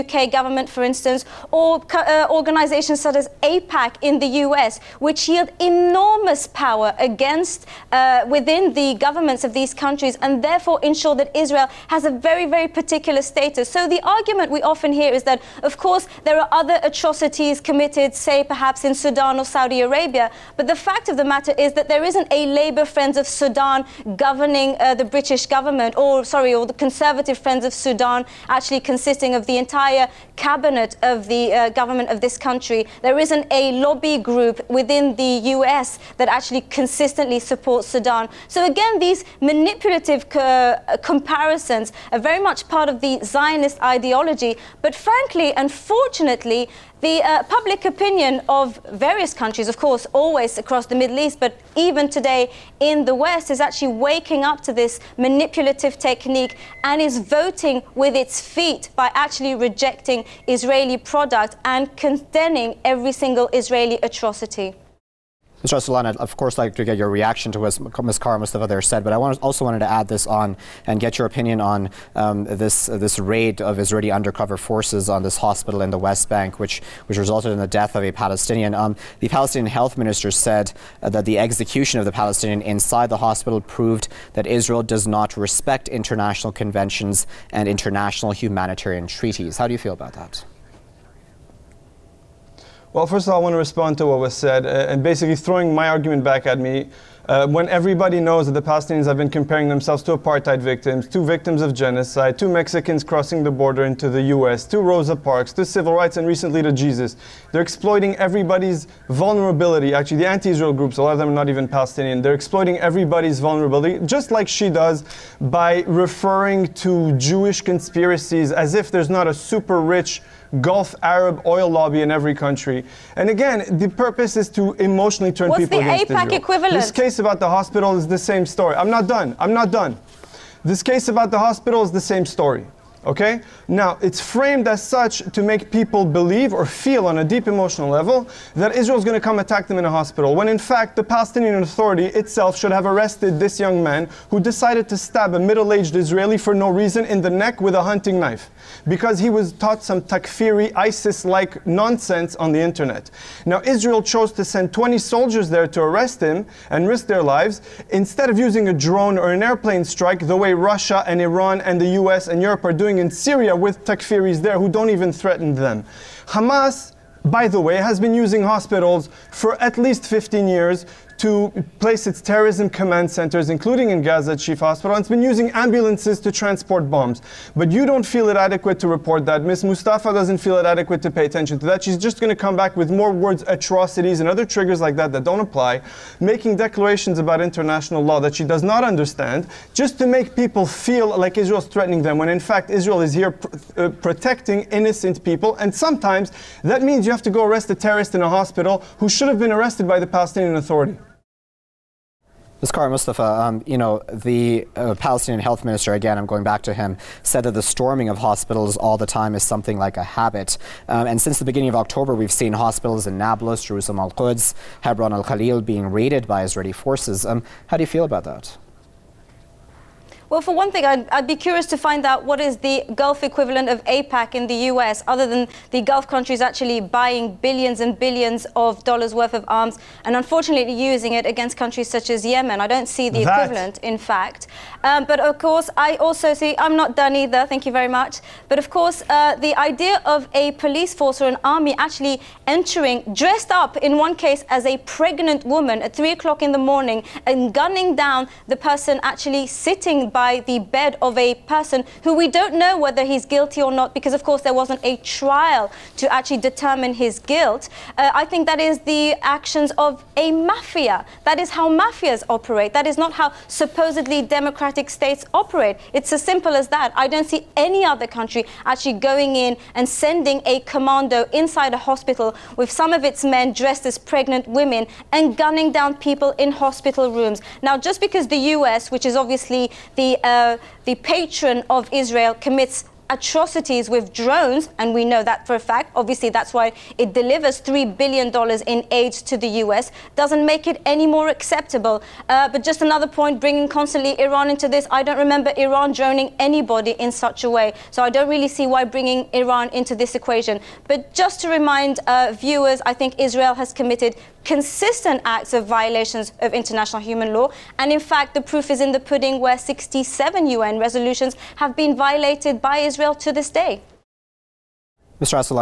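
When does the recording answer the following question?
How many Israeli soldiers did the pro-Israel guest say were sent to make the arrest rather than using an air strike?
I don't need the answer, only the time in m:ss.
2:34.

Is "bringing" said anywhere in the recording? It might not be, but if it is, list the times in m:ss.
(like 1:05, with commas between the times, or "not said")
4:53, 4:58.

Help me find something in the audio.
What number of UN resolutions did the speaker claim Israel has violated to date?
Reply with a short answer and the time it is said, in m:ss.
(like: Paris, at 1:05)
67, at 5:09.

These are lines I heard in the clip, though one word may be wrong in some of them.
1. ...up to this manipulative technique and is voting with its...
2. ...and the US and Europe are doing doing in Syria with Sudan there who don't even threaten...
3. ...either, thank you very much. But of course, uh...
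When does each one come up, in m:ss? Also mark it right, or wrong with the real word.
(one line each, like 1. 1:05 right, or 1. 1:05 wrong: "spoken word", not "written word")
1. 0:54 right
2. 2:41 wrong: "Takfiris", not "Sudan"
3. 3:57 right.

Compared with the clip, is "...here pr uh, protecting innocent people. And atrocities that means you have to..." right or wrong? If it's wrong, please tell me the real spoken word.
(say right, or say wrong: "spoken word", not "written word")
wrong: "sometimes", not "atrocities".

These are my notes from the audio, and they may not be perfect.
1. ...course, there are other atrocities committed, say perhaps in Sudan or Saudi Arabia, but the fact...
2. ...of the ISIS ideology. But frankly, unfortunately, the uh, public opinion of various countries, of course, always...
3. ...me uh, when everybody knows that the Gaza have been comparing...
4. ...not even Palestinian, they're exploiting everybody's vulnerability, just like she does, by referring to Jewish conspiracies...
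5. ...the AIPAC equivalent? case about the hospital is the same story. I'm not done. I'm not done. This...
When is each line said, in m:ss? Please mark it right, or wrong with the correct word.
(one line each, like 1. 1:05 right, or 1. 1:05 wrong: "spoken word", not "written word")
1. 0:15 right
2. 0:42 wrong: "Zionist", not "ISIS"
3. 1:36 wrong: "Palestinians", not "Gaza"
4. 1:51 right
5. 2:06 right.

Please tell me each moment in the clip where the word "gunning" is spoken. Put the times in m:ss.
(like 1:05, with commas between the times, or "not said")
4:07, 4:35.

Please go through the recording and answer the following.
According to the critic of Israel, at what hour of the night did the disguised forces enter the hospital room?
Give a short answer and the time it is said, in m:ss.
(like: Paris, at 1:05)
3 o'clock in the morning, at 4:05.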